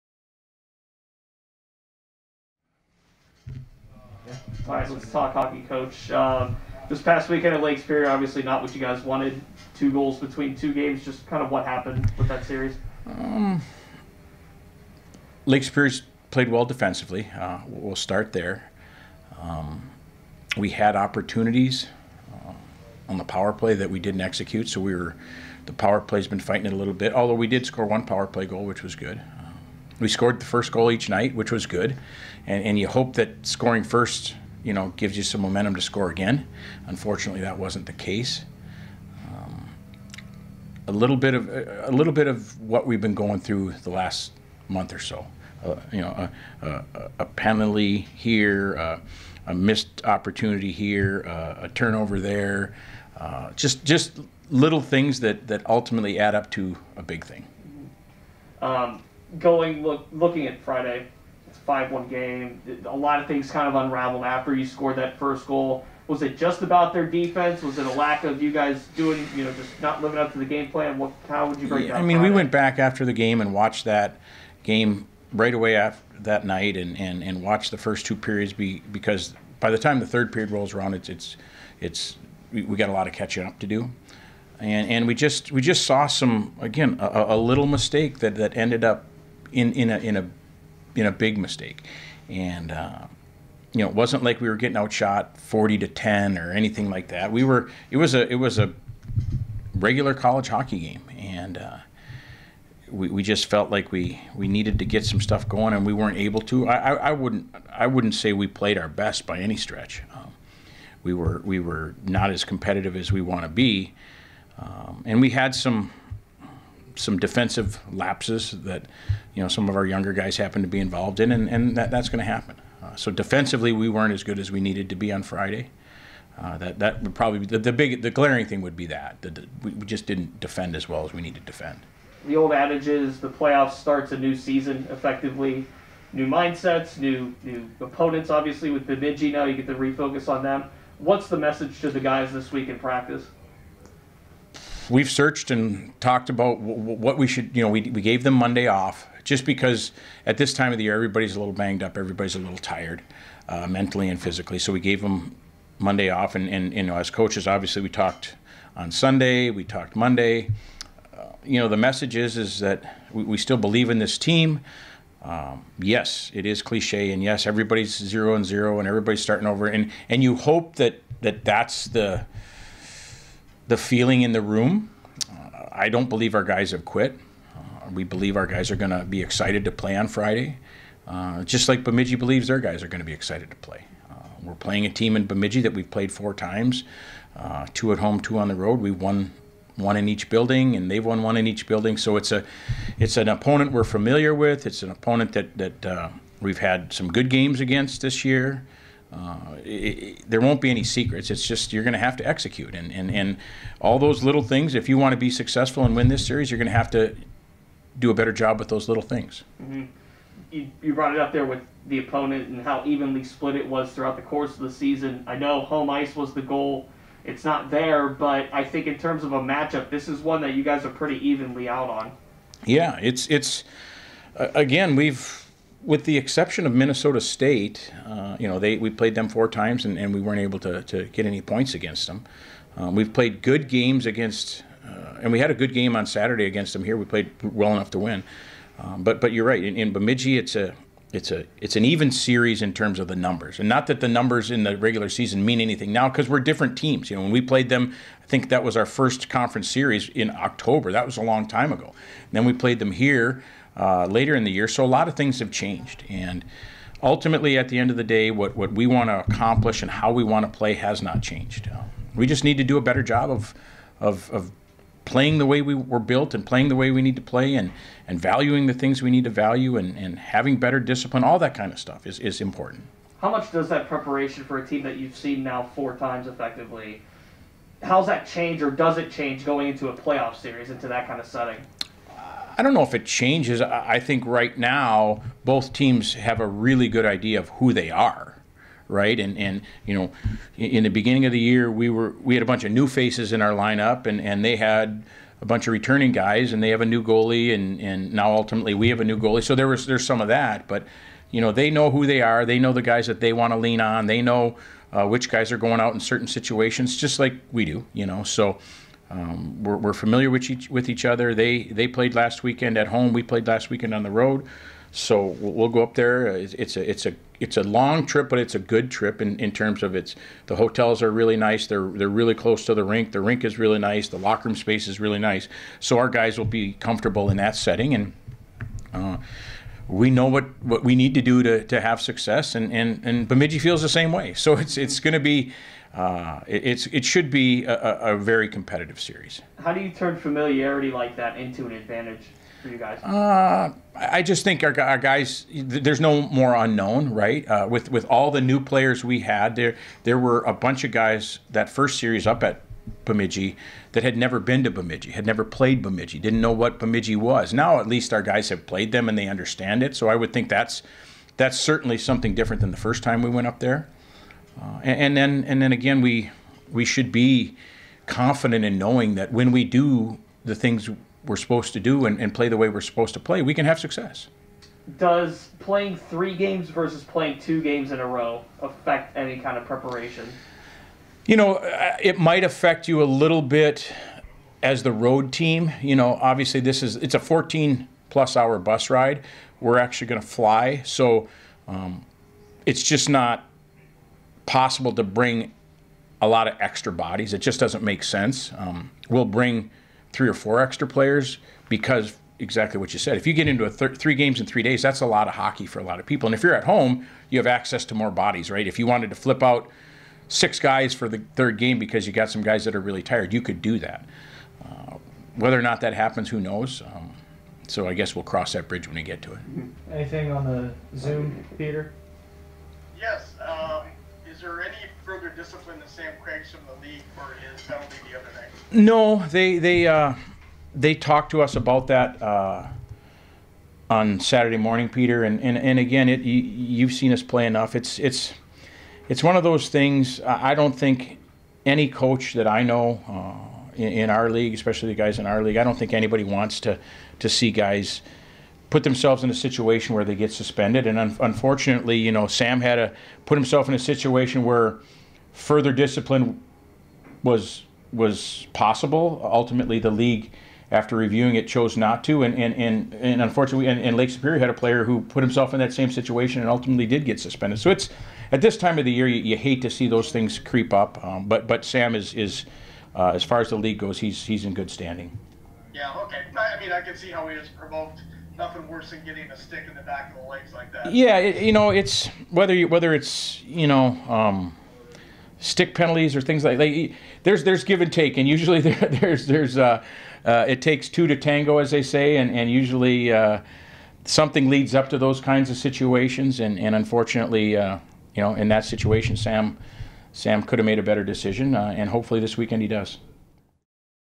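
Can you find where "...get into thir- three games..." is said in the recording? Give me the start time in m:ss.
6:43.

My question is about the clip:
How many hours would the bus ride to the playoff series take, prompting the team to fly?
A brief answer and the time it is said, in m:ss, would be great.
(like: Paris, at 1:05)
14 plus hours, at 6:27.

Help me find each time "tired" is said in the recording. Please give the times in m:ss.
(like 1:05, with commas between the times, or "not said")
2:32, 6:53.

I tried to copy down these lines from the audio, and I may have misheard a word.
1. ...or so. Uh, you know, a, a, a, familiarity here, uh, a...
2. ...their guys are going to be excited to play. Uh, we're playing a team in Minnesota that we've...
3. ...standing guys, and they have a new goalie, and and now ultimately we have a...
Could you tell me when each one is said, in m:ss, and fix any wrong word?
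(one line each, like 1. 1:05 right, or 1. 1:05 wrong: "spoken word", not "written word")
1. 0:44 wrong: "penalty", not "familiarity"
2. 3:02 wrong: "Bemidji", not "Minnesota"
3. 4:55 wrong: "returning", not "standing".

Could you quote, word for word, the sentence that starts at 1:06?
Was it just about their defense?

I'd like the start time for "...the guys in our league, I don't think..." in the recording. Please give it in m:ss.
7:24.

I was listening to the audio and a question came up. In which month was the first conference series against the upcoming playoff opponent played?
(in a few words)
October.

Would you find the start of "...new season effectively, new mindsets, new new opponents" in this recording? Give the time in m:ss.
2:14.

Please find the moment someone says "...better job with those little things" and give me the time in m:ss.
3:28.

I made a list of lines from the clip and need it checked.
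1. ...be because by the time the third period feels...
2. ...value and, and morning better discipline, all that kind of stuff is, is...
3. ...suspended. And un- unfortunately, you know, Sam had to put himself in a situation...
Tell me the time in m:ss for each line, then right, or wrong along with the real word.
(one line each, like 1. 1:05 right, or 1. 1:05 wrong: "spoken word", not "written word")
1. 1:18 wrong: "rolls", not "feels"
2. 4:29 wrong: "having", not "morning"
3. 7:30 right.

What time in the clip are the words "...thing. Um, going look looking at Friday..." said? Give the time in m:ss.
0:57.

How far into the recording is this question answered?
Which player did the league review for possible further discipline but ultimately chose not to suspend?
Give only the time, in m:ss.
7:05.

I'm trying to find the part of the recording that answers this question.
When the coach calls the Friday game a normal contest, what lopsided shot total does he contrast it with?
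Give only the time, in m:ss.
1:35.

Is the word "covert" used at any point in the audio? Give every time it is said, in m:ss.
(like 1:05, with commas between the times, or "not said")
not said.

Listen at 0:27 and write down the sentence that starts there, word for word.
Although we did score one power play goal, which was good.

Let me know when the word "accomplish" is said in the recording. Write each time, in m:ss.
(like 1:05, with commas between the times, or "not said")
4:19.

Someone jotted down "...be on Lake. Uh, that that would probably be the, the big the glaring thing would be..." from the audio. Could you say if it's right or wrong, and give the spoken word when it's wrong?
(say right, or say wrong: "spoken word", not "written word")
wrong: "Friday", not "Lake".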